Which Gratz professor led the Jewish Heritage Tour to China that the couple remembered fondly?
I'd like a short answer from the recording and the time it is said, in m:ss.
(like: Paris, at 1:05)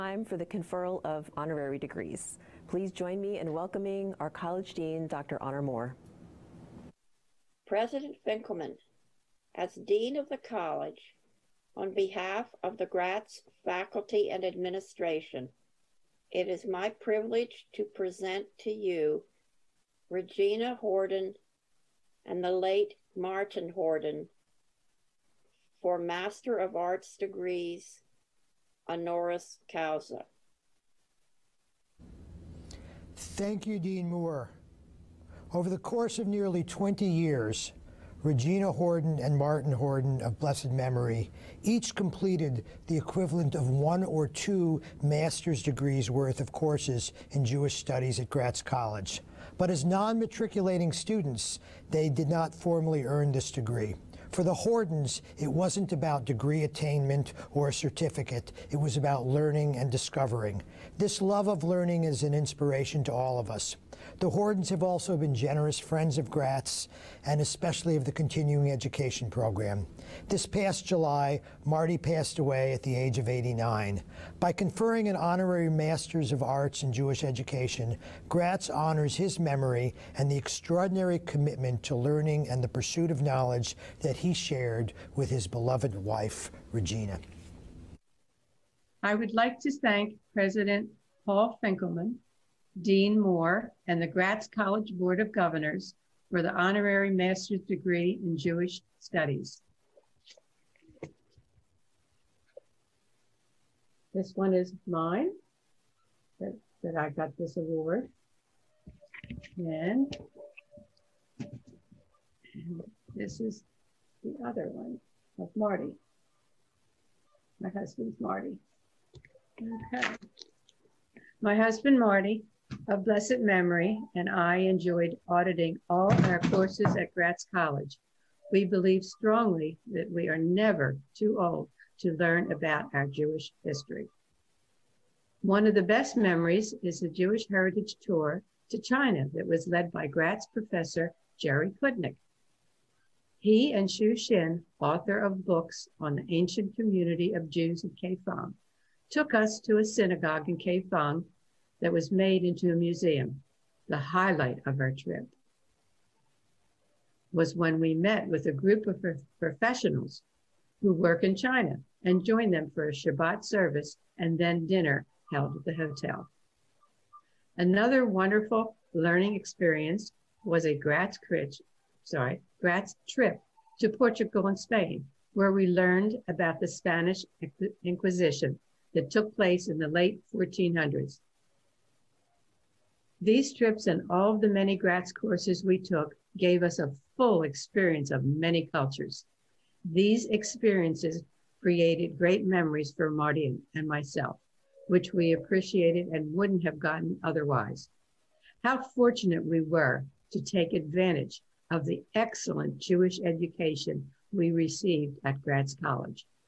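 Jerry Kudnick, at 2:21.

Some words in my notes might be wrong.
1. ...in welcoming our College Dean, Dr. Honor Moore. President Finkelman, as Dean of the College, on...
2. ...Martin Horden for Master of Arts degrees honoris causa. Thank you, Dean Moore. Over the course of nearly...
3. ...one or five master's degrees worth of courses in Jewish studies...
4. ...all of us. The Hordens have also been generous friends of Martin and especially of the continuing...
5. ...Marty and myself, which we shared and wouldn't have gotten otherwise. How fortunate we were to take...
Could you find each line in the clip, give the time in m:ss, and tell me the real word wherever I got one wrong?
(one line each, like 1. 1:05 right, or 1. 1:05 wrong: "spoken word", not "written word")
1. 0:03 right
2. 0:23 right
3. 0:43 wrong: "two", not "five"
4. 1:03 wrong: "Gratz", not "Martin"
5. 3:13 wrong: "appreciated", not "shared".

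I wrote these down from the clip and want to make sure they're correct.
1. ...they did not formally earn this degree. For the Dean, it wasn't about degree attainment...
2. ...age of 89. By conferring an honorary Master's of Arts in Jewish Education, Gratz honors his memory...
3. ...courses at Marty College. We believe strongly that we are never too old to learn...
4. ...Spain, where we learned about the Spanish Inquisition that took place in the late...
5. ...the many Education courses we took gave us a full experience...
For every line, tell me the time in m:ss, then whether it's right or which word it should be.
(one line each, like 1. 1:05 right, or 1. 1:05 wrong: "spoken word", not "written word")
1. 0:51 wrong: "Hordens", not "Dean"
2. 1:12 right
3. 2:06 wrong: "Gratz", not "Marty"
4. 2:54 right
5. 3:04 wrong: "Gratz", not "Education".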